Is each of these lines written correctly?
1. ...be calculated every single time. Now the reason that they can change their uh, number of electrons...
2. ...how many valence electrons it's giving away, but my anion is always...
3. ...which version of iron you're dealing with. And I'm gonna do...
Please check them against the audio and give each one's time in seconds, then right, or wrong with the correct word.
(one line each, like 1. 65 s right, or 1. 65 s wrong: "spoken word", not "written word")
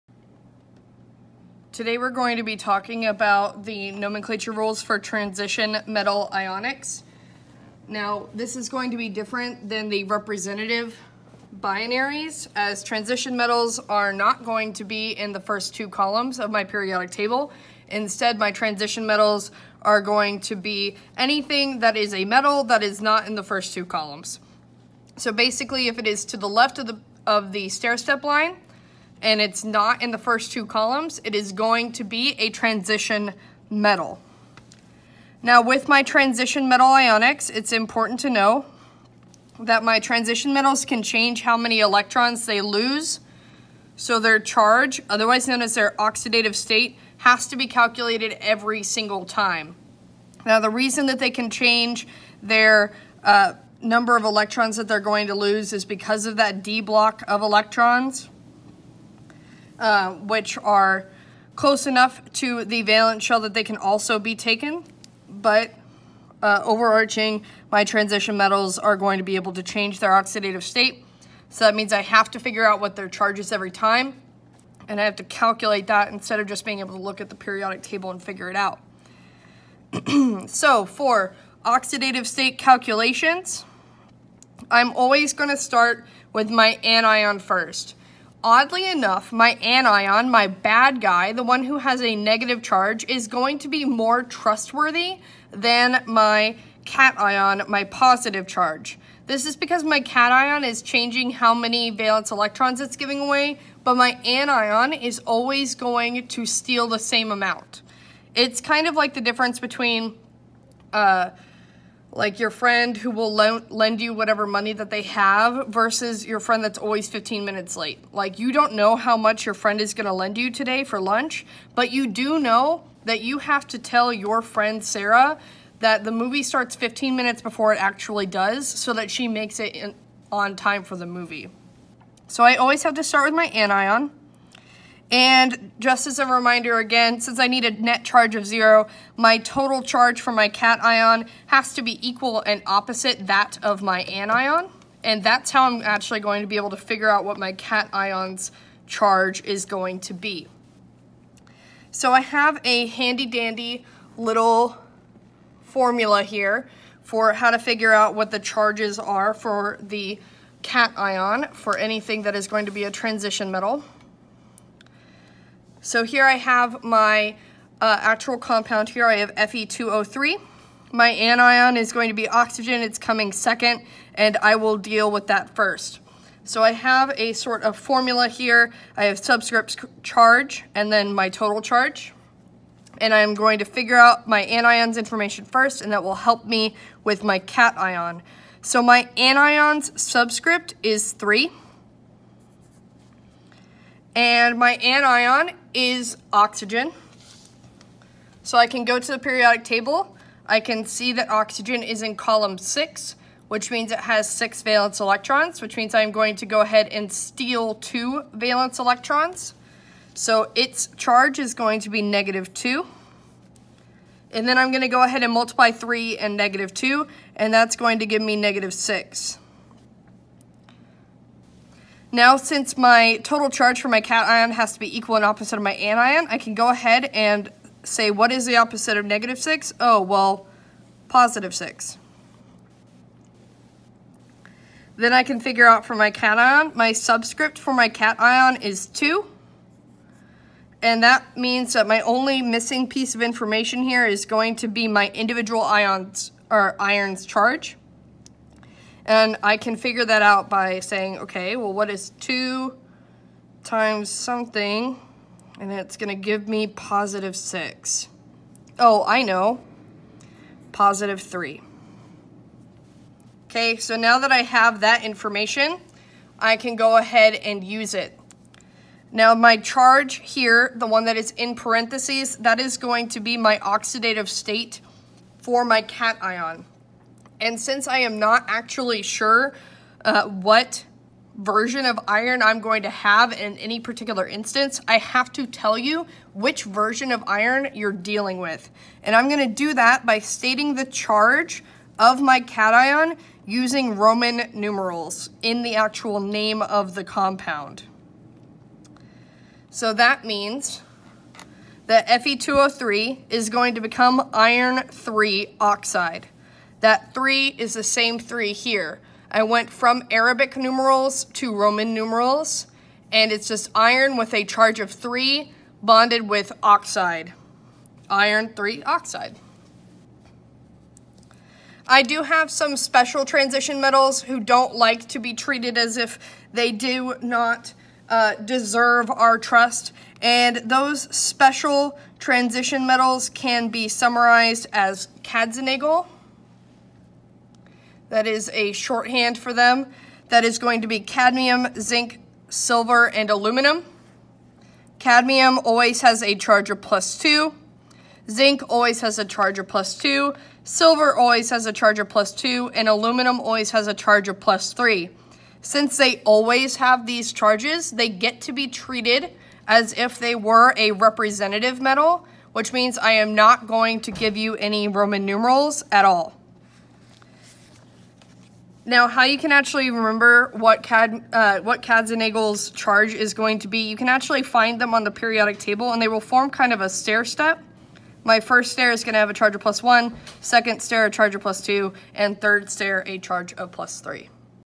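1. 47 s right
2. 101 s right
3. 286 s right.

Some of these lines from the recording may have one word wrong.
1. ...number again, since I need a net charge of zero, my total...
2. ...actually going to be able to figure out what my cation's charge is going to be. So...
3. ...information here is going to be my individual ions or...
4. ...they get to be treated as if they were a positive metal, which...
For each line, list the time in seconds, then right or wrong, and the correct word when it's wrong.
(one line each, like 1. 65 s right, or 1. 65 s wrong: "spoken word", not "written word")
1. 136 s wrong: "reminder", not "number"
2. 145 s right
3. 243 s right
4. 357 s wrong: "representative", not "positive".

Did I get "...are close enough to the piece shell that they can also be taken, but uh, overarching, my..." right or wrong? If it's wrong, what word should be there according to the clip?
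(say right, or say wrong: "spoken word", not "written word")
wrong: "valence", not "piece".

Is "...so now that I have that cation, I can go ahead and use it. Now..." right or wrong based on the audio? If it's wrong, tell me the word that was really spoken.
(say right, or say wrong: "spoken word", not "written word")
wrong: "information", not "cation".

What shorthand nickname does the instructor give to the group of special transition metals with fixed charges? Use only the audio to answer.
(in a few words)
Kadzenagel.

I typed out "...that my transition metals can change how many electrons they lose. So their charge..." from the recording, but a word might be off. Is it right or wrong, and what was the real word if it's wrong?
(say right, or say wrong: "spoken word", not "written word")
right.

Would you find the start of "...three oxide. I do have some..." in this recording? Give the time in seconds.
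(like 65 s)
318 s.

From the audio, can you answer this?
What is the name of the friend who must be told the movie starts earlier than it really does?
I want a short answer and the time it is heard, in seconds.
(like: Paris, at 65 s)
Sarah, at 124 s.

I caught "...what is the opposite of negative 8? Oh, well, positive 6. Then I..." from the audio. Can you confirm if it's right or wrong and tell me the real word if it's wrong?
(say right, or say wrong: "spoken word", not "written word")
wrong: "6", not "8".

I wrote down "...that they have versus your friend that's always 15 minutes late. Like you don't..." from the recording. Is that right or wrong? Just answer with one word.
right.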